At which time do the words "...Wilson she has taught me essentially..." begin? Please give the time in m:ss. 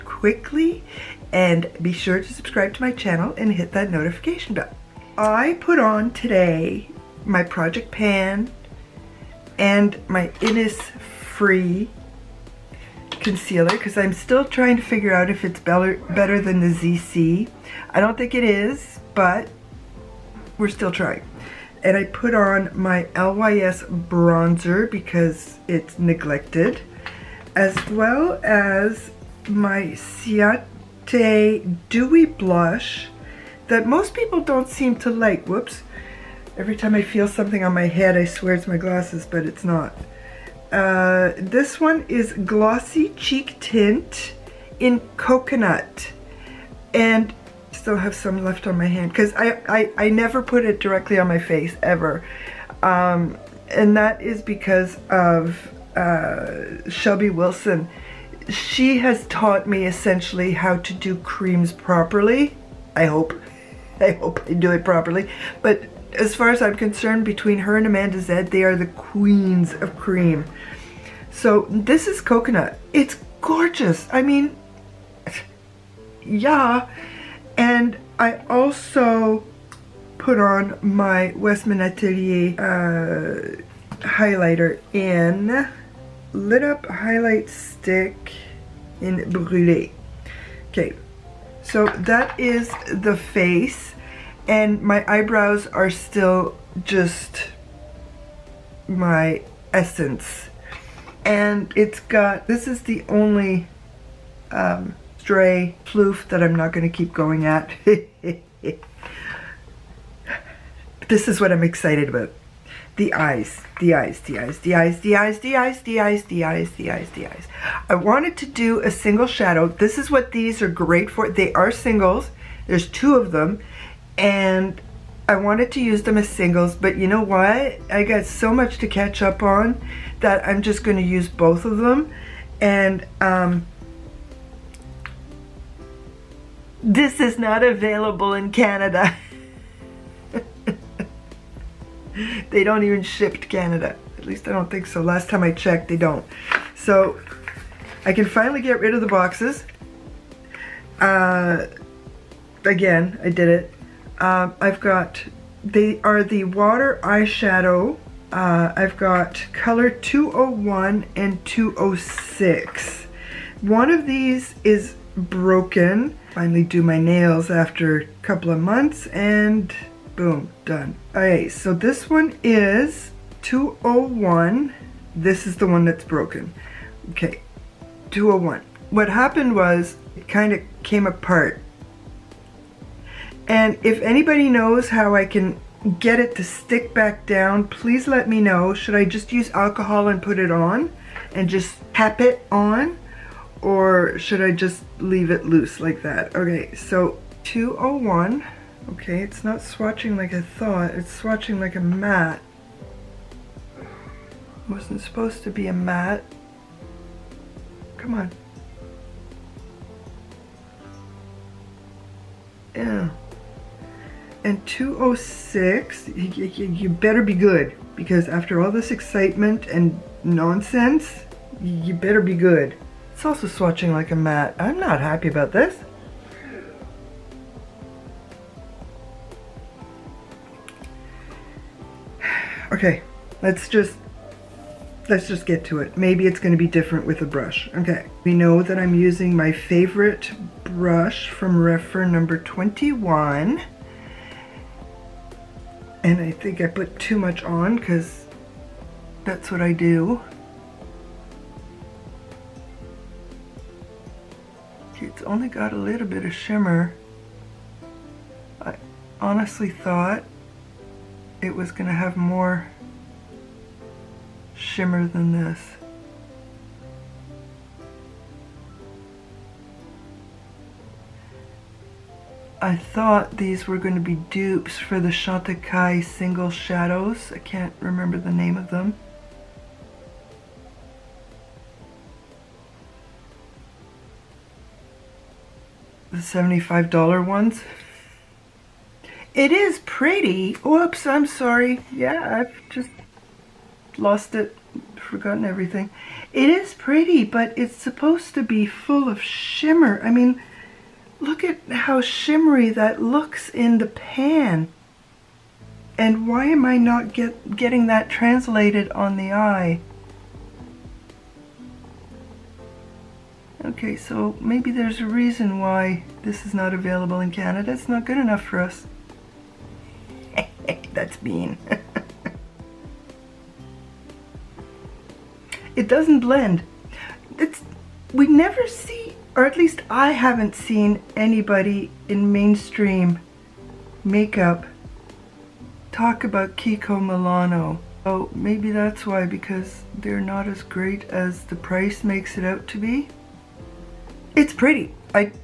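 0:57.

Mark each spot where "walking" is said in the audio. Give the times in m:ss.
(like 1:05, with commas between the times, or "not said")
not said.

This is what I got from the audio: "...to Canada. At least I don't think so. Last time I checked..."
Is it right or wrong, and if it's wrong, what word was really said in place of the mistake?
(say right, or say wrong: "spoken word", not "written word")
right.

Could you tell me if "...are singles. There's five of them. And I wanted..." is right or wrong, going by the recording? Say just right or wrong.
wrong.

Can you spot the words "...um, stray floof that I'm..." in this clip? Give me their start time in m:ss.
1:44.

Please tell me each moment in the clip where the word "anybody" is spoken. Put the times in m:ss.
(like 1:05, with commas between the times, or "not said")
3:04, 5:31.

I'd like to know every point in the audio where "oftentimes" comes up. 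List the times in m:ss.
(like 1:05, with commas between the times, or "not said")
not said.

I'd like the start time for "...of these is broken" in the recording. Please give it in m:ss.
2:43.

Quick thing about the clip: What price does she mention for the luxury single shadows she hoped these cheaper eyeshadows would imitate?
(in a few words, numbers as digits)
$75.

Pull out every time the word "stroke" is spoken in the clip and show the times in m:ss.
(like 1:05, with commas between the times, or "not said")
not said.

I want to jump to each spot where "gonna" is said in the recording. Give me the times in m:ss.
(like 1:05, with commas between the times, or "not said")
3:56.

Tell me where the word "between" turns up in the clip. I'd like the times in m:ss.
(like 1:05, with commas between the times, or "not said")
1:07.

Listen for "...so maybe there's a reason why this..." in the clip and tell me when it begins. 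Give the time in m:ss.
5:13.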